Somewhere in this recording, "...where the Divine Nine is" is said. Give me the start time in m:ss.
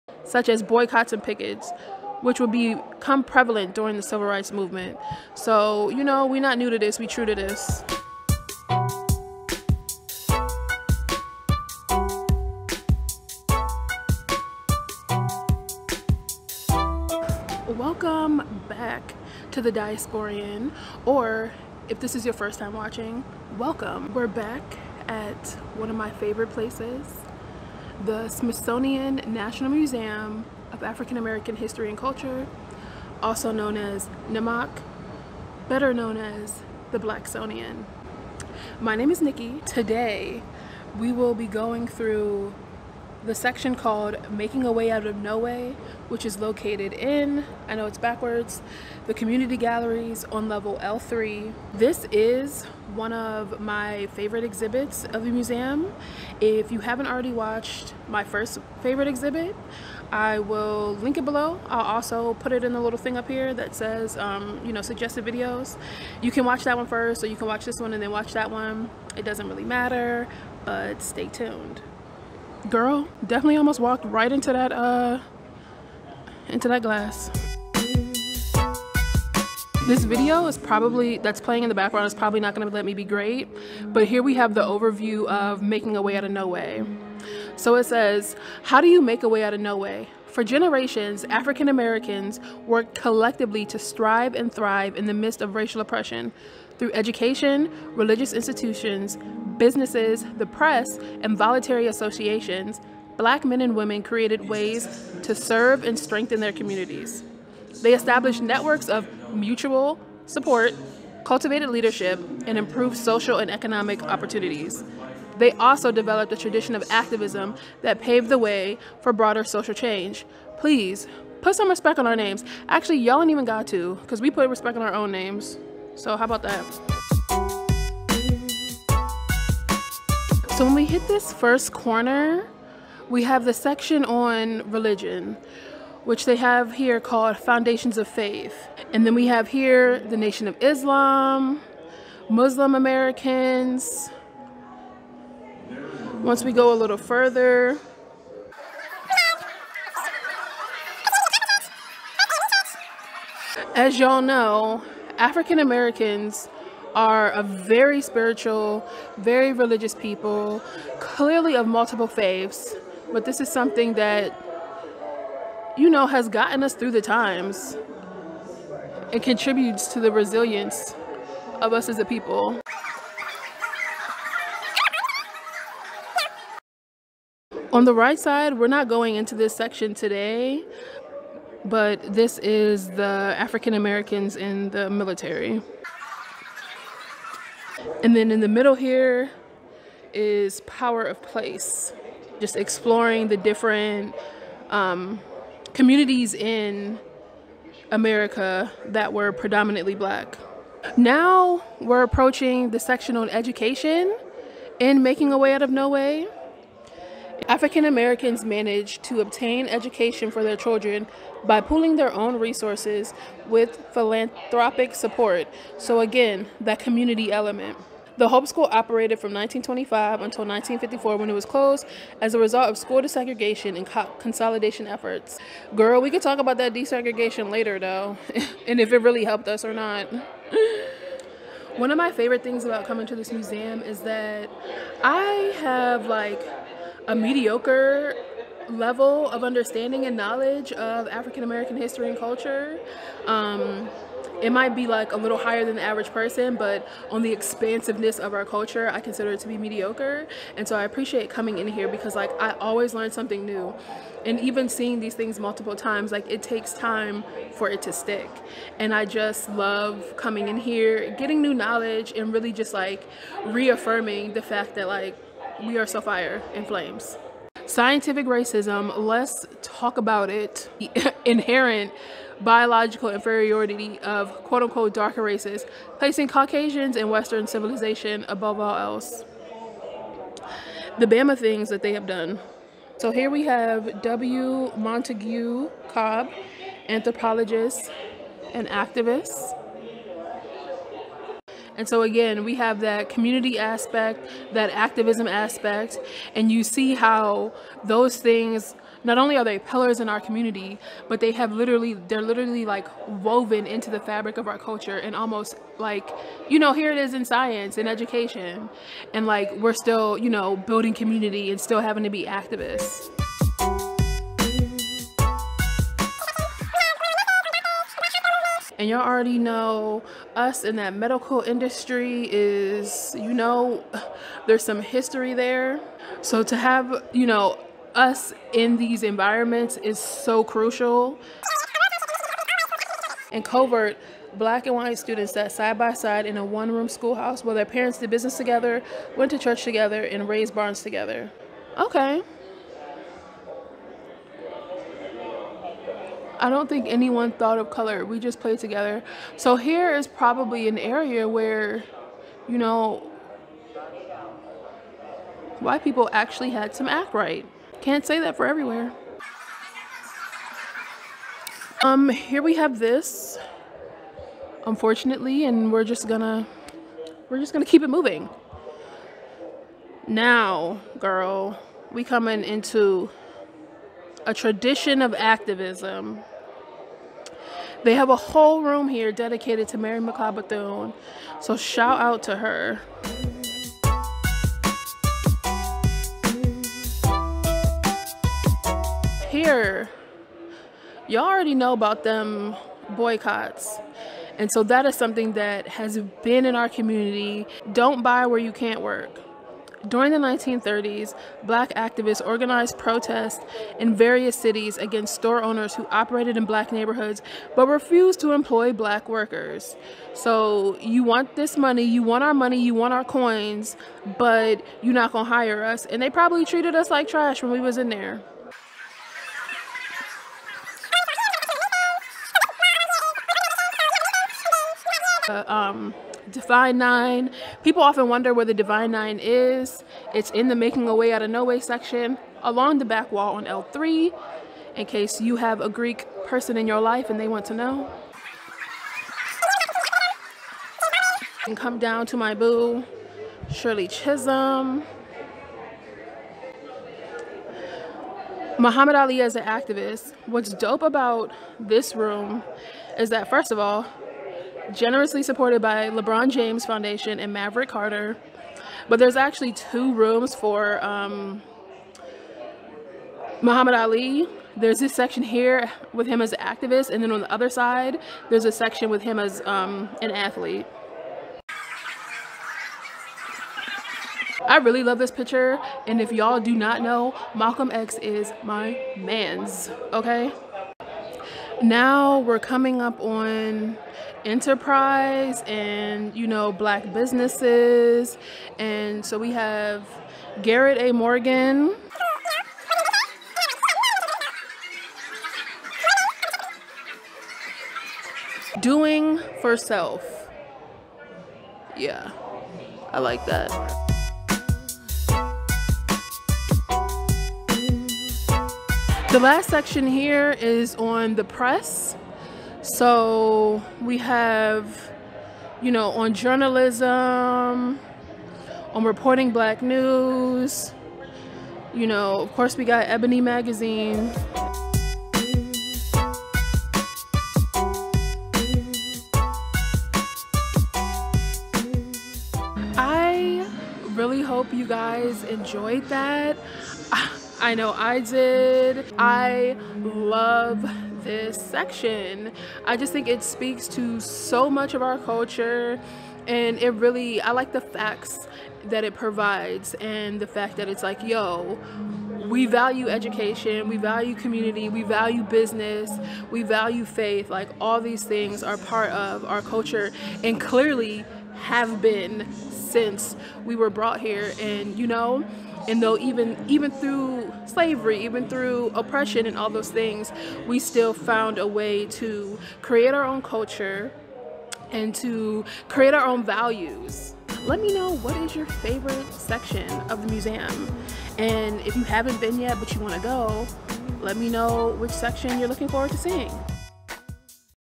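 7:08.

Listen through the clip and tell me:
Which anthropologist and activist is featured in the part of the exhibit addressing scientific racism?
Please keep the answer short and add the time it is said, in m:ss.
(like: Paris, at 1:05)
W. Montague Cobb, at 4:44.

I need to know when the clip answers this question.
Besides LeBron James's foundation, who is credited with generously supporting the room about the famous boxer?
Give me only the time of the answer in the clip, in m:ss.
7:37.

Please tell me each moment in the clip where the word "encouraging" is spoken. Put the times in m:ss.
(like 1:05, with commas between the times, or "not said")
not said.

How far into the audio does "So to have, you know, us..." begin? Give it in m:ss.
5:26.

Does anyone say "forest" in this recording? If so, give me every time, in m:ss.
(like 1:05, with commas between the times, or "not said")
not said.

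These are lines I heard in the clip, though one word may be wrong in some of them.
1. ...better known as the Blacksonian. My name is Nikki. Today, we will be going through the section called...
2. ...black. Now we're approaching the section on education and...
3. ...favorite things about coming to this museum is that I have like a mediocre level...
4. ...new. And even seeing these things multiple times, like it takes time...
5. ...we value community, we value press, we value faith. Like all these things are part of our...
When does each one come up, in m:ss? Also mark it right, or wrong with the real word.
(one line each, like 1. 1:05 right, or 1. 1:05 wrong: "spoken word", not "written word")
1. 0:35 right
2. 3:19 right
3. 3:52 right
4. 4:13 right
5. 9:13 wrong: "business", not "press".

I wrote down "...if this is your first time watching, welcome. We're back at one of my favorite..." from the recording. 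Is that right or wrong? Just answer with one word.
right.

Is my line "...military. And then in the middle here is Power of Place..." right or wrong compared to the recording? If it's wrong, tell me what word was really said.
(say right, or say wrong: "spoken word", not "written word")
right.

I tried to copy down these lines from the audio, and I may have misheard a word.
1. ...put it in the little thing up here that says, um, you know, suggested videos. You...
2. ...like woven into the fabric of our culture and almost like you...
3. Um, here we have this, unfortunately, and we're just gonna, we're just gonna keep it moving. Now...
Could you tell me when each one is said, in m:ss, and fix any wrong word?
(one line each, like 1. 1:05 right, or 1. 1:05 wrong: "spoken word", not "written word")
1. 1:02 right
2. 5:02 right
3. 6:01 right.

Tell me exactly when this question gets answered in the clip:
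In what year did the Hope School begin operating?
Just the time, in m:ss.
3:39.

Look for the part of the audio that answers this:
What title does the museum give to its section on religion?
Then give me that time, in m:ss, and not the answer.
2:17.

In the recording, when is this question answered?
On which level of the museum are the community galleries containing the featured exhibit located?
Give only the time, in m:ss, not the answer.
0:50.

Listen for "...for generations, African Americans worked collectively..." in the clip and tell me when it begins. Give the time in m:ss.
1:30.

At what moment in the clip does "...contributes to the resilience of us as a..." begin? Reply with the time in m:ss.
2:49.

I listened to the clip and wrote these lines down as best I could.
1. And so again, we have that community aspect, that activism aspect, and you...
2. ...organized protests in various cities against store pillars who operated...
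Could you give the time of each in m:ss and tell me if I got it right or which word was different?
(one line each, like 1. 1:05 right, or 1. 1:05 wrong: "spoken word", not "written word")
1. 4:51 right
2. 6:42 wrong: "owners", not "pillars".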